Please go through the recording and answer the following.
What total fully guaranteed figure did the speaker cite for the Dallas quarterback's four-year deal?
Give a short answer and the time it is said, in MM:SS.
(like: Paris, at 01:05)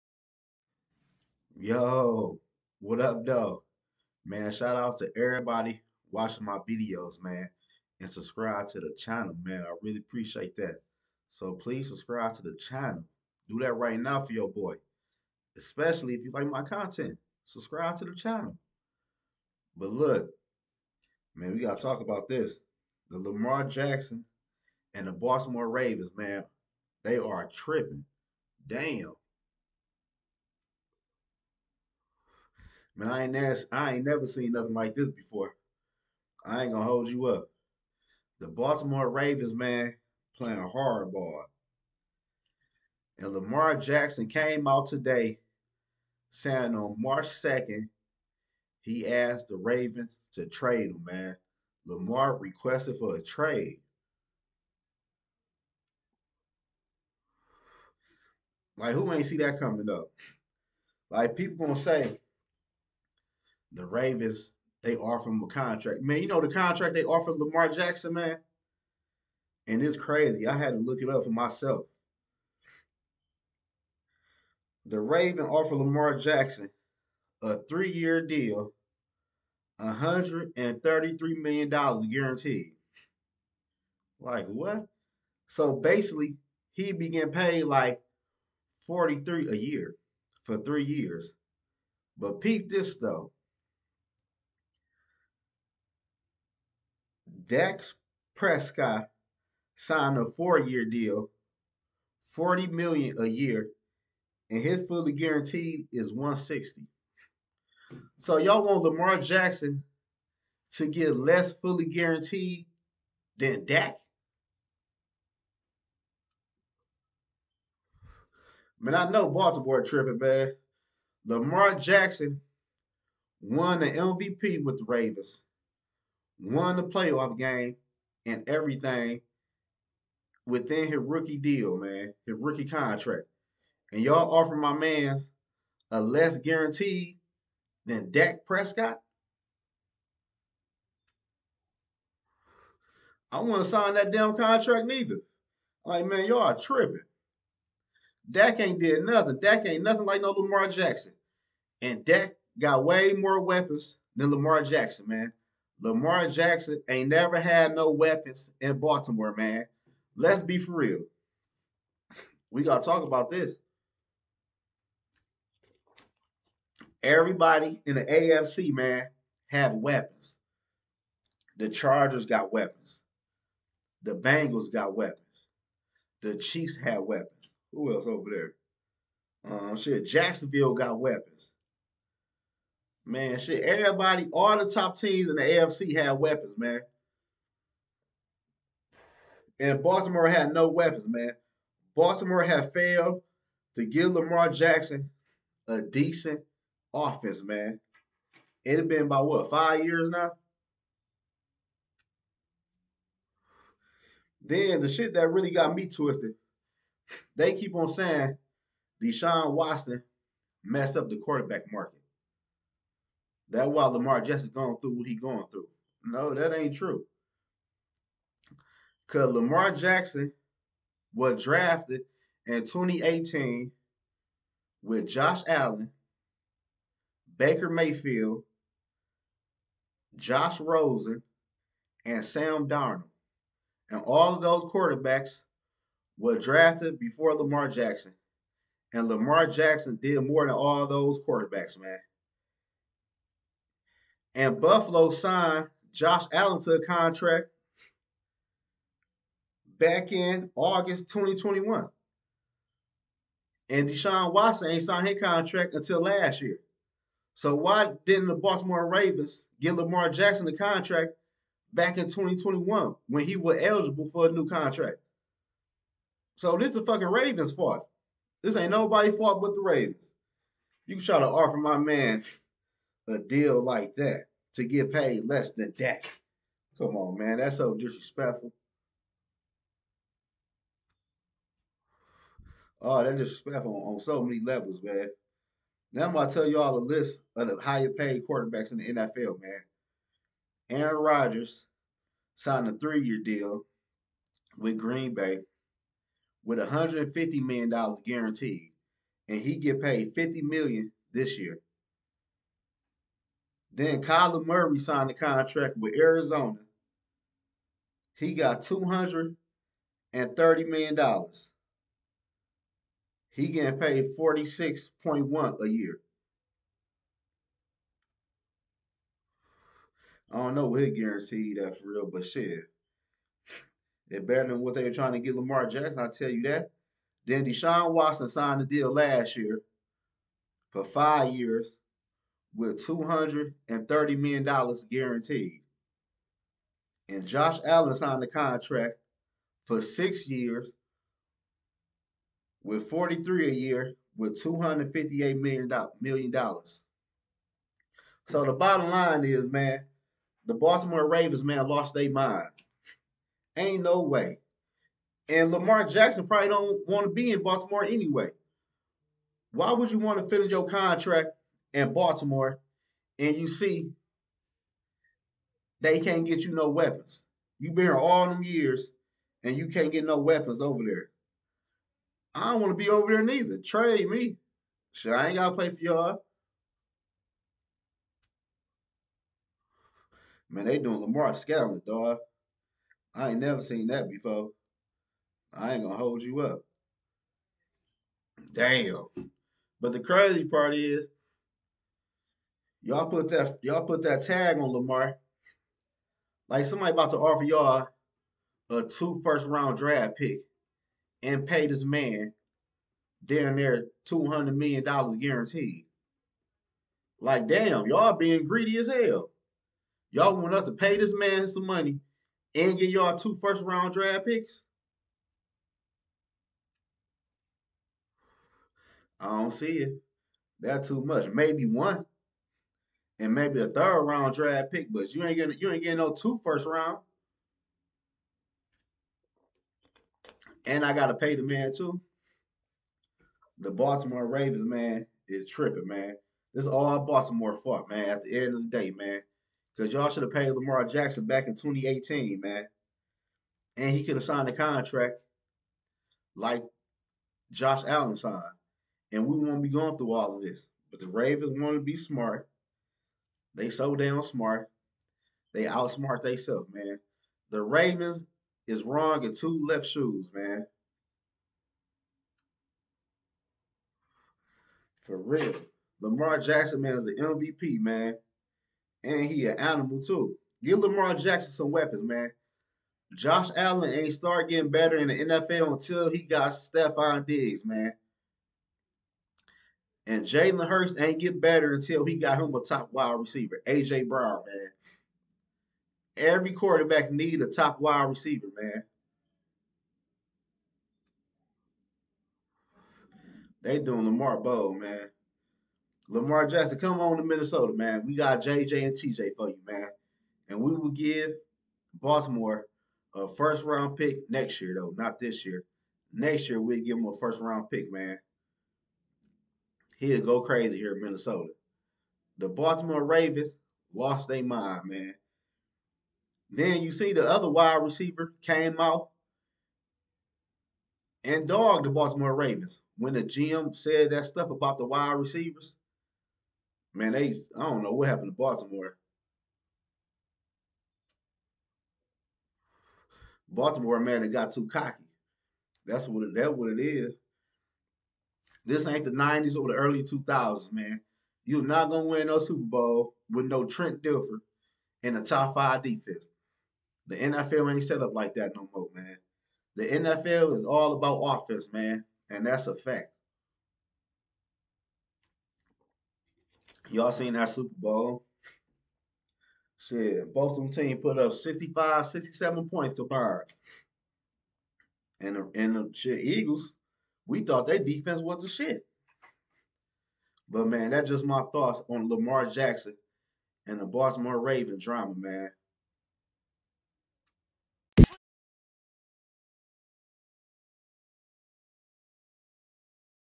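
160, at 01:46.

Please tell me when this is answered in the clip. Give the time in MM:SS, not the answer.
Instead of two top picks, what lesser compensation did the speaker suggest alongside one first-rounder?
07:03.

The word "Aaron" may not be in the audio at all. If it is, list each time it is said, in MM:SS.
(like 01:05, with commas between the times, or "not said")
04:50.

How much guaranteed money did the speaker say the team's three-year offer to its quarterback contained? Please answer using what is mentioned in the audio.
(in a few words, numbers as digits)
$133 million.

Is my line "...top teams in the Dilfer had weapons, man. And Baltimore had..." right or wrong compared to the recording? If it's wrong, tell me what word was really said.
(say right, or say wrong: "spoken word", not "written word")
wrong: "AFC", not "Dilfer".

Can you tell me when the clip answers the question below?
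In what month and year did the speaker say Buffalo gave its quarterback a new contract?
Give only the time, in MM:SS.
04:10.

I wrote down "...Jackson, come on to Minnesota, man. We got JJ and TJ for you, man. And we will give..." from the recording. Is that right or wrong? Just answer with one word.
right.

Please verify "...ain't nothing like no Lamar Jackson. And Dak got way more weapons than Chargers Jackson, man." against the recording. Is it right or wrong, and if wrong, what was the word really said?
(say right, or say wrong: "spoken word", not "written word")
wrong: "Lamar", not "Chargers".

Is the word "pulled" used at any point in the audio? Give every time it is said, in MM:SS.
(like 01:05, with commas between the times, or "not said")
not said.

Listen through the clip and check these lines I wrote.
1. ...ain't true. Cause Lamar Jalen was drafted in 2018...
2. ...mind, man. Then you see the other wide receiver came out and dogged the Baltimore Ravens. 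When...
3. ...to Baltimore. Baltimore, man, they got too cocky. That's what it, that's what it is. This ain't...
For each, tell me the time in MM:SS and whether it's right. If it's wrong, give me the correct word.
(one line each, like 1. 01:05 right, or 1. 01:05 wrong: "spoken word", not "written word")
1. 03:36 wrong: "Jackson", not "Jalen"
2. 08:34 right
3. 08:48 right.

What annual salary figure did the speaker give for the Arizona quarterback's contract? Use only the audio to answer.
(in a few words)
46.1 million.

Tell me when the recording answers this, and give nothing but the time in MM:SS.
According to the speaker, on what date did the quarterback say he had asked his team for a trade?
00:46.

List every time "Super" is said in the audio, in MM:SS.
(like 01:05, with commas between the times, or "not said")
09:02, 09:17.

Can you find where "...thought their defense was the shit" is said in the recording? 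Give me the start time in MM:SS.
09:27.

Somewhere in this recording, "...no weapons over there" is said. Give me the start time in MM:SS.
06:10.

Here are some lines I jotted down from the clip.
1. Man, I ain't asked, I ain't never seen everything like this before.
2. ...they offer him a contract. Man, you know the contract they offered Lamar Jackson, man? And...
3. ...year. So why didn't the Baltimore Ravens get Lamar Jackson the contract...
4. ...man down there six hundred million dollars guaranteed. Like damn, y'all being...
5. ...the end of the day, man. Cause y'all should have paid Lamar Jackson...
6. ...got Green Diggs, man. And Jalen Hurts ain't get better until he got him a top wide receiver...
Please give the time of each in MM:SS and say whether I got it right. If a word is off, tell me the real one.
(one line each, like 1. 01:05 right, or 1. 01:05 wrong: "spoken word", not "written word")
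1. 00:33 wrong: "nothing", not "everything"
2. 01:04 right
3. 04:16 right
4. 06:41 wrong: "two", not "six"
5. 07:18 right
6. 07:56 wrong: "Stefon", not "Green".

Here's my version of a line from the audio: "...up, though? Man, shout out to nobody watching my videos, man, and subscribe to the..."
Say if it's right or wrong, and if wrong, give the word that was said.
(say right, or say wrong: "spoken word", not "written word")
wrong: "everybody", not "nobody".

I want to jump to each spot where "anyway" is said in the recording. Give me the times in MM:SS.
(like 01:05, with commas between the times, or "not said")
05:57.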